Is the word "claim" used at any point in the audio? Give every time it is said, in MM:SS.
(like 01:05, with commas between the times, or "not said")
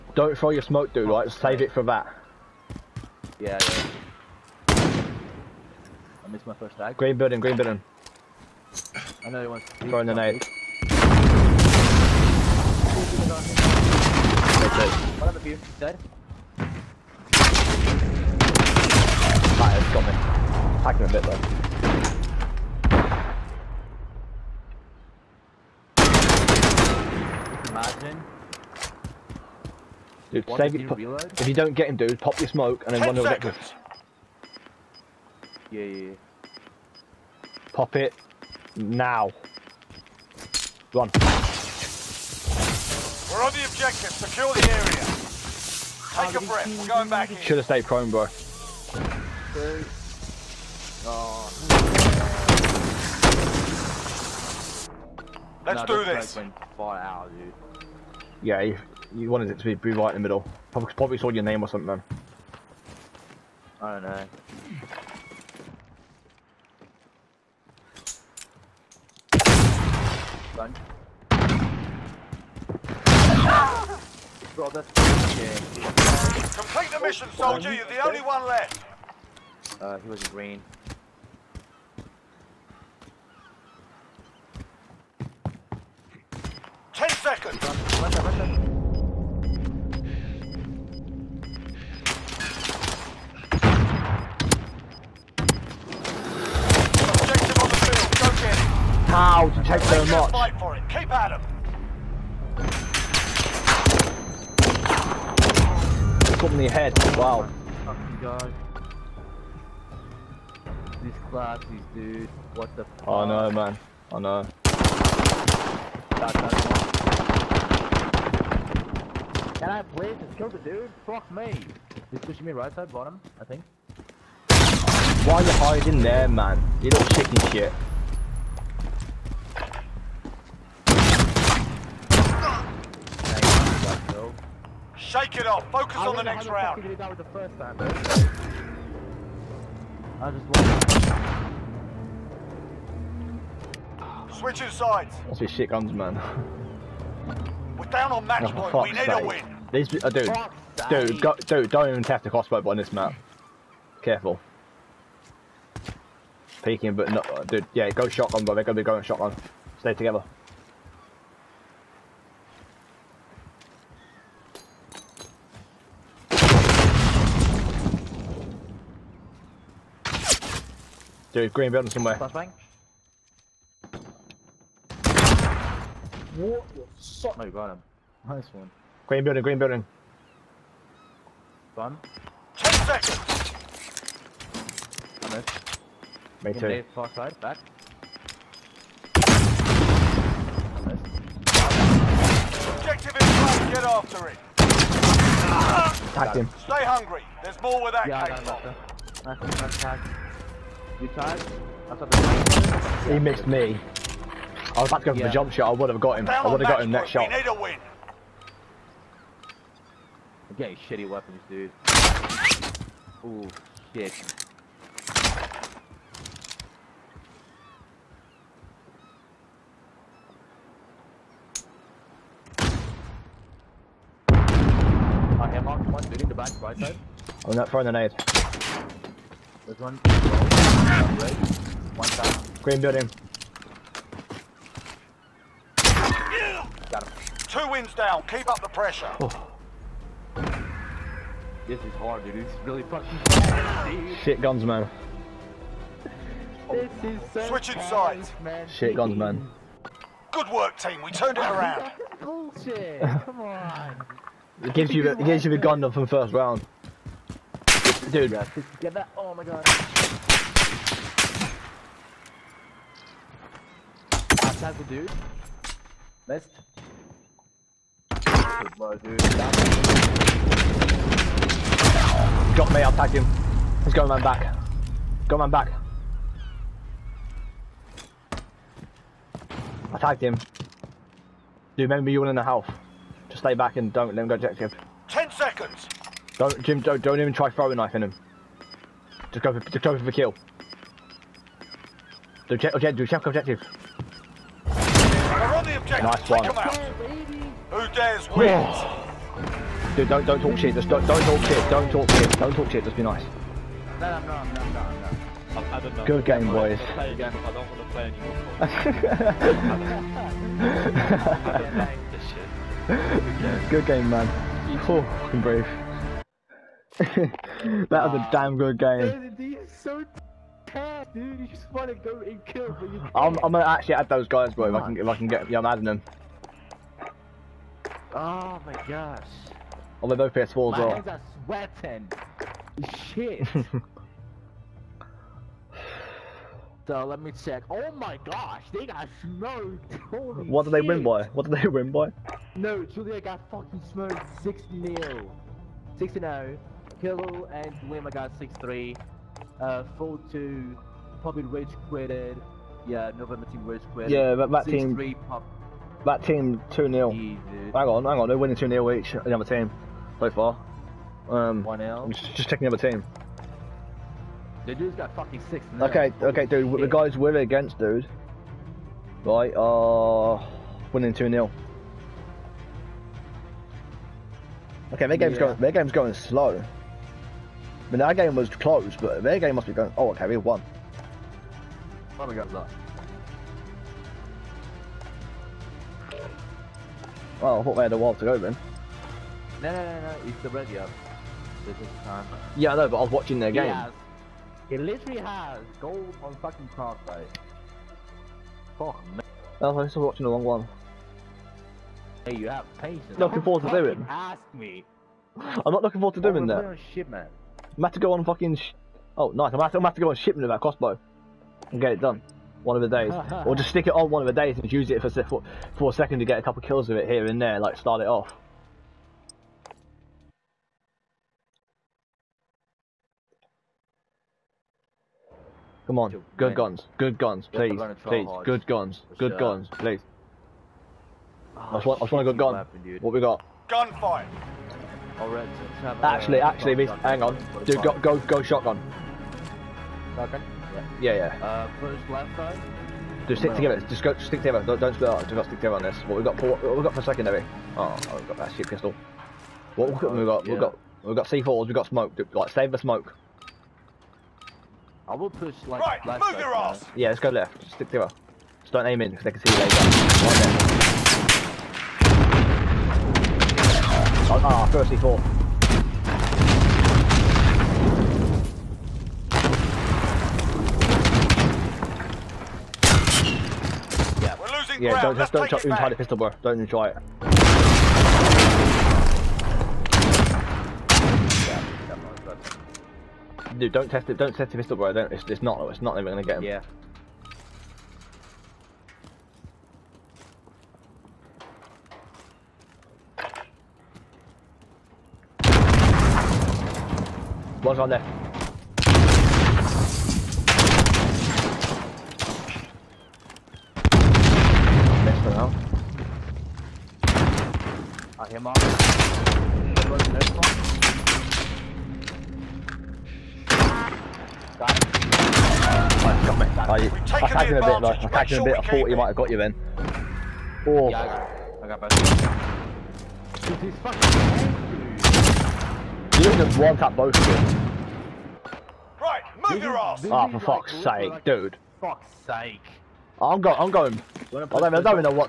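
not said.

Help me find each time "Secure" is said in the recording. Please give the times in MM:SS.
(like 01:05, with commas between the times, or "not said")
00:44.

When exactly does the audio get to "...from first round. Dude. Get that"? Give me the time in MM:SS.
04:15.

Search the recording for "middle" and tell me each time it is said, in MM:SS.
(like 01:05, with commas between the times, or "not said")
01:00.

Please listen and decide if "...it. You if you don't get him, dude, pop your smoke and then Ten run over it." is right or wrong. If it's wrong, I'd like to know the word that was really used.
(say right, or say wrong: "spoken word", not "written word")
right.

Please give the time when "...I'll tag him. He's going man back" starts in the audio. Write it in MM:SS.
04:32.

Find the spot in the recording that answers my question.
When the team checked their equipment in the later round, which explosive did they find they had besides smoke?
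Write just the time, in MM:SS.
07:31.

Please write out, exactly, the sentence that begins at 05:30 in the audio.
Oh, they're both PS4 as well.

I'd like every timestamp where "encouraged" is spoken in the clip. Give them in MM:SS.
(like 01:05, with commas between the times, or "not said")
not said.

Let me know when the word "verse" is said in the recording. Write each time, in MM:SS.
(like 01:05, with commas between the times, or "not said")
not said.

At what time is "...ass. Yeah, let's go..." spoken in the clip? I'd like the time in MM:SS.
07:36.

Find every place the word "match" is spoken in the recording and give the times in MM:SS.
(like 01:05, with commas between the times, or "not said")
02:28.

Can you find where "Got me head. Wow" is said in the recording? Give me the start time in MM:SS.
01:46.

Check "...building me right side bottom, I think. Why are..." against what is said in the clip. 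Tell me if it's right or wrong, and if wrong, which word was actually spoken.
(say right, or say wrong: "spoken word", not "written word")
wrong: "pushing", not "building".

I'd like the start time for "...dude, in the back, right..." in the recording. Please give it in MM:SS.
03:46.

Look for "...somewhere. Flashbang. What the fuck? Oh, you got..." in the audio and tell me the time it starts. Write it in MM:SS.
02:51.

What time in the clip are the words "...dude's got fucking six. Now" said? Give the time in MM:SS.
06:04.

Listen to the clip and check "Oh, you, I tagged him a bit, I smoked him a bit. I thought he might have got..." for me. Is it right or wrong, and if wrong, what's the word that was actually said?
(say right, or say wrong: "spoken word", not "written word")
wrong: "tagged", not "smoked".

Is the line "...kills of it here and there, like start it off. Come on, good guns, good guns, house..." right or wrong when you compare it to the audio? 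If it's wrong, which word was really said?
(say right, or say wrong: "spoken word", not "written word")
wrong: "please", not "house".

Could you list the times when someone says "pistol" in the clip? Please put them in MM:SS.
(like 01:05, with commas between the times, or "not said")
07:28, 07:55, 08:04.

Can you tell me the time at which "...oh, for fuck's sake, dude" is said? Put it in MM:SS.
08:50.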